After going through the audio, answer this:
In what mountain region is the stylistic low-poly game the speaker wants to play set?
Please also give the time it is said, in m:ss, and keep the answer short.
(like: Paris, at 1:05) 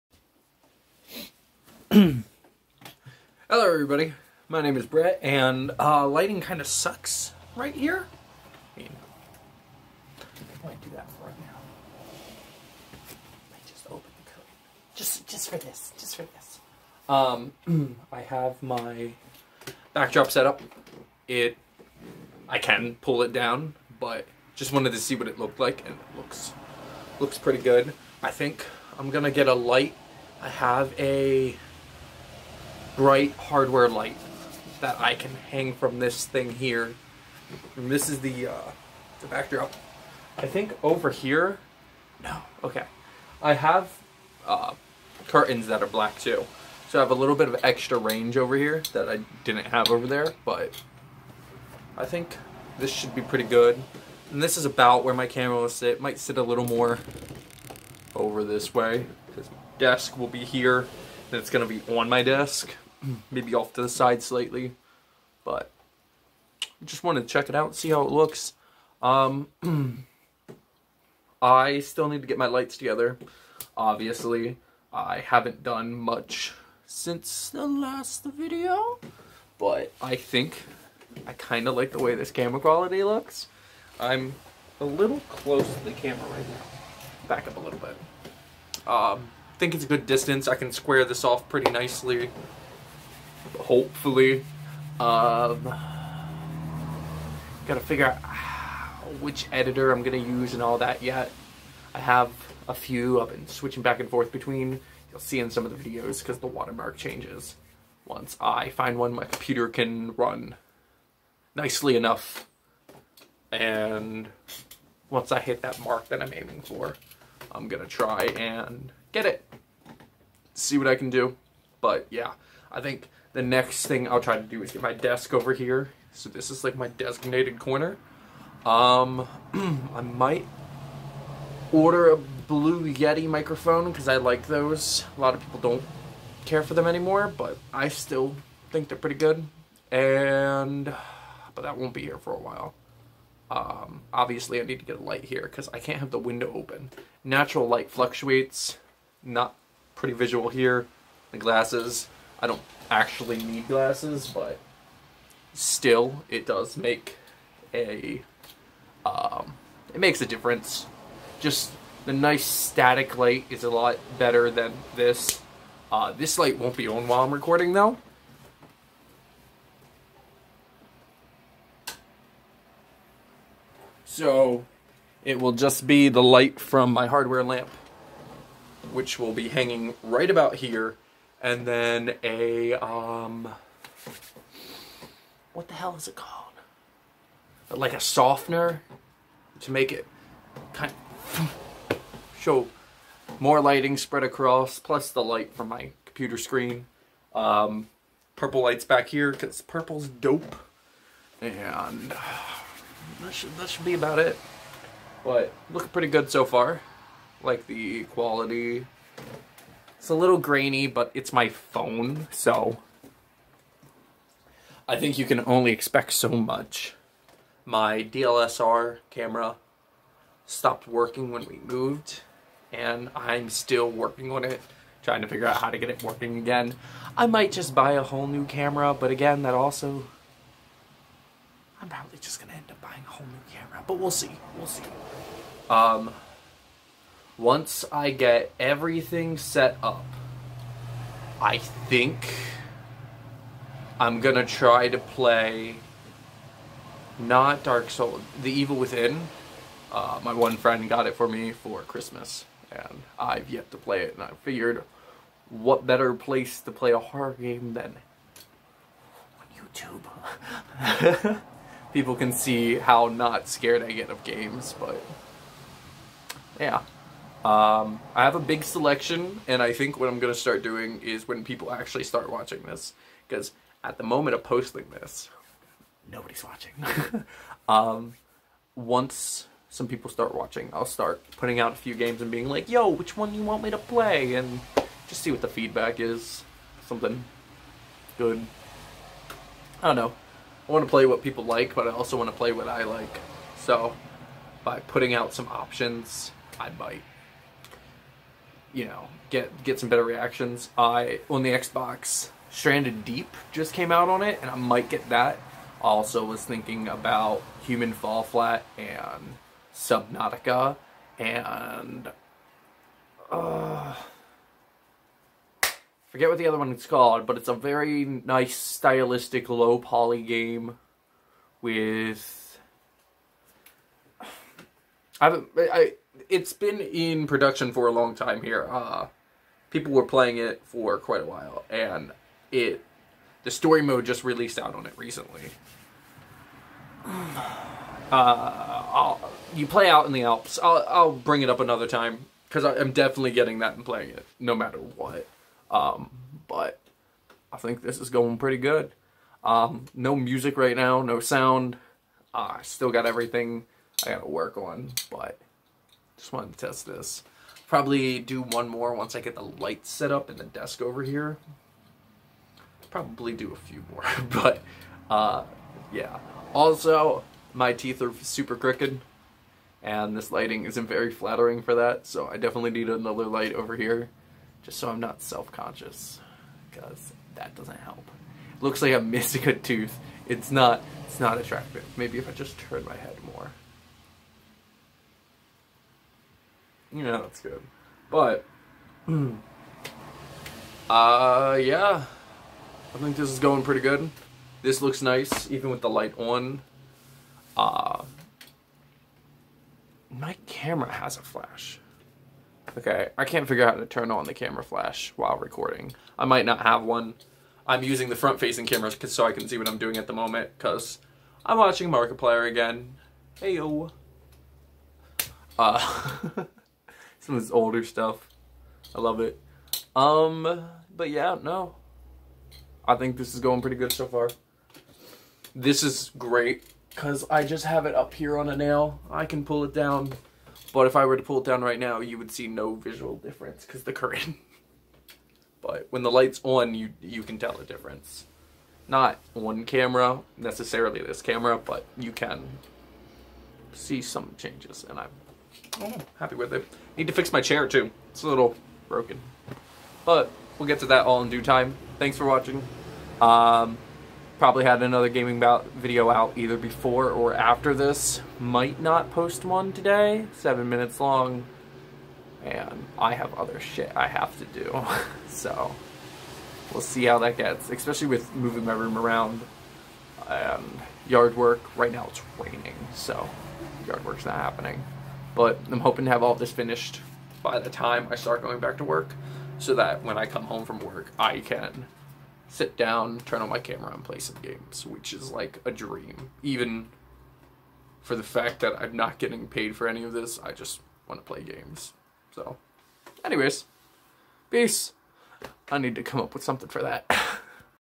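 The Alps, at 5:40.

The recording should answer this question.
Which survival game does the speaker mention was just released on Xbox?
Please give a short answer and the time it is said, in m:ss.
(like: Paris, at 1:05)
Stranded Deep, at 5:02.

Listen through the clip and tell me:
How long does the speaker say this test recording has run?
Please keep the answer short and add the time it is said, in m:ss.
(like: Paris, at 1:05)
7 minutes, at 7:40.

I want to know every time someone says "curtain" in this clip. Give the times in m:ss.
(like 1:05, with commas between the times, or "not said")
0:14, 0:45.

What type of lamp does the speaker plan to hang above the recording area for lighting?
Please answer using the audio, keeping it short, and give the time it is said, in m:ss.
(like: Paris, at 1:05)
Hardware light, at 0:33.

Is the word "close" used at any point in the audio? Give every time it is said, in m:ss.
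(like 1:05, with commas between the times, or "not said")
1:25.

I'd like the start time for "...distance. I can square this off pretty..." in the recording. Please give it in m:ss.
1:30.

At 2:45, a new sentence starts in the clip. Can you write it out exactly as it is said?
Uh, this light won't be on while I'm recording though.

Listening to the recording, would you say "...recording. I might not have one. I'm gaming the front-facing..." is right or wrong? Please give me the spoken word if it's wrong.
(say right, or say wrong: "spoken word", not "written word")
wrong: "using", not "gaming".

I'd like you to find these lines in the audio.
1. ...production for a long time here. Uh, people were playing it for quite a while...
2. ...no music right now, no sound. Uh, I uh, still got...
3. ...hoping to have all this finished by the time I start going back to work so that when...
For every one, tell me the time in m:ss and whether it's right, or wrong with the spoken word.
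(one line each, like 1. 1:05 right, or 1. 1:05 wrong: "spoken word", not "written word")
1. 5:27 right
2. 5:49 right
3. 7:55 right.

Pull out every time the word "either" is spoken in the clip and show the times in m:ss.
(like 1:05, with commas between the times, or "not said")
7:36.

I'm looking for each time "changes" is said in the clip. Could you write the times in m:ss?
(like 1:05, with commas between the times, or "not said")
1:46, 7:24.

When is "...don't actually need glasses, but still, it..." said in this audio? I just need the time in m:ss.
2:32.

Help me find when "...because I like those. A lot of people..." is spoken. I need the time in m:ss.
2:13.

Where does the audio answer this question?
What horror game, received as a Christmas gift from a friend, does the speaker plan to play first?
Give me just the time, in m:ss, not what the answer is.
4:08.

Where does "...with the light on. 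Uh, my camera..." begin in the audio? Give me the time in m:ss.
6:35.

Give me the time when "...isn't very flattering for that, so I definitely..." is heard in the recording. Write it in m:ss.
6:10.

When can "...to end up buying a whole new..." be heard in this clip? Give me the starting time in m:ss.
3:52.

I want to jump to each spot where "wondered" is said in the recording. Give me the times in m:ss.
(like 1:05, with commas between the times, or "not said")
not said.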